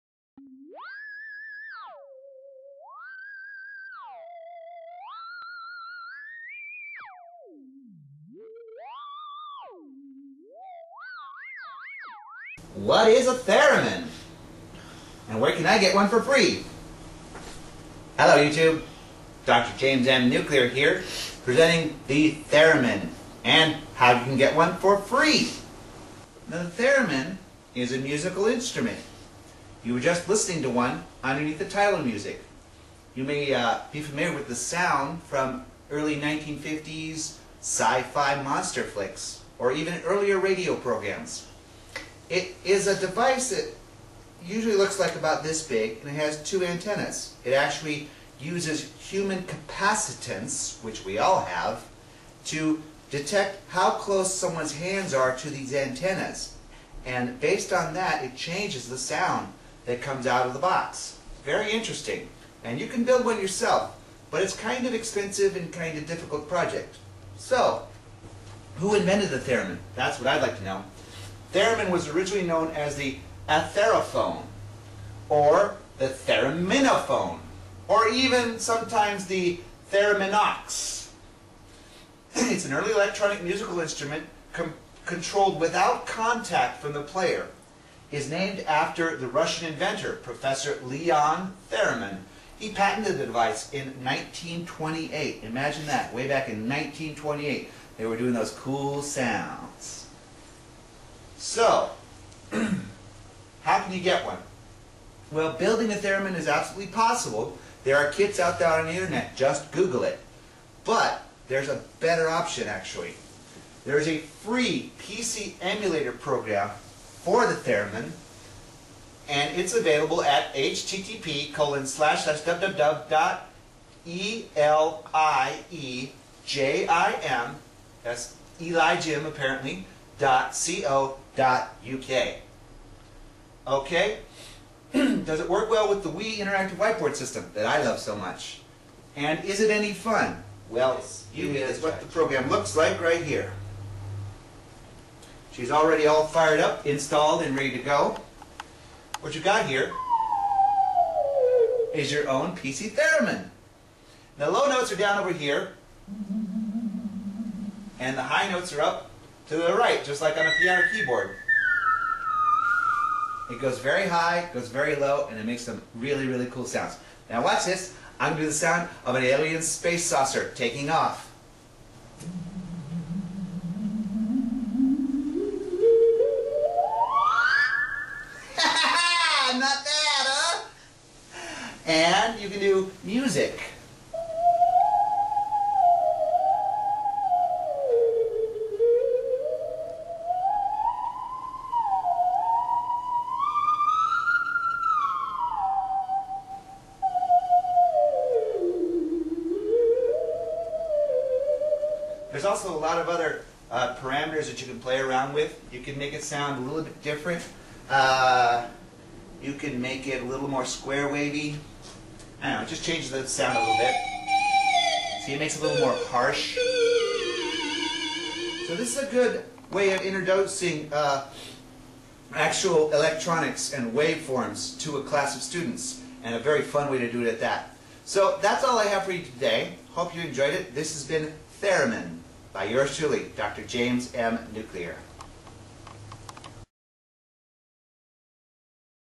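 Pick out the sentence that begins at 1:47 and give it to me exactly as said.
There are kits out there on the internet.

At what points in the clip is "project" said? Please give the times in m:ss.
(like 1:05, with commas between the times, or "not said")
1:06.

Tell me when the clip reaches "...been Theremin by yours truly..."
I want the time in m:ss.
3:51.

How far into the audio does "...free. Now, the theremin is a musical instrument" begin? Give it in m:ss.
0:24.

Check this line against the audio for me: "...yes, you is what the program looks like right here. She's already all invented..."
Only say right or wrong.
wrong.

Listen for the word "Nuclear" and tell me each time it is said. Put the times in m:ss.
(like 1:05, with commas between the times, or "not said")
0:20, 3:54.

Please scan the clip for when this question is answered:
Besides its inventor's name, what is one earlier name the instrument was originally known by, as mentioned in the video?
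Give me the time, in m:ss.
1:13.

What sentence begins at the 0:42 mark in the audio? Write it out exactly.
It is a device that usually looks like about this big, and it has two antennas.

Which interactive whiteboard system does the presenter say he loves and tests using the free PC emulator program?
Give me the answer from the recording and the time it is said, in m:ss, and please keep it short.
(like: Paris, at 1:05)
Wii interactive whiteboard, at 2:16.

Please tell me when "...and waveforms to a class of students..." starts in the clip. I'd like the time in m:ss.
3:43.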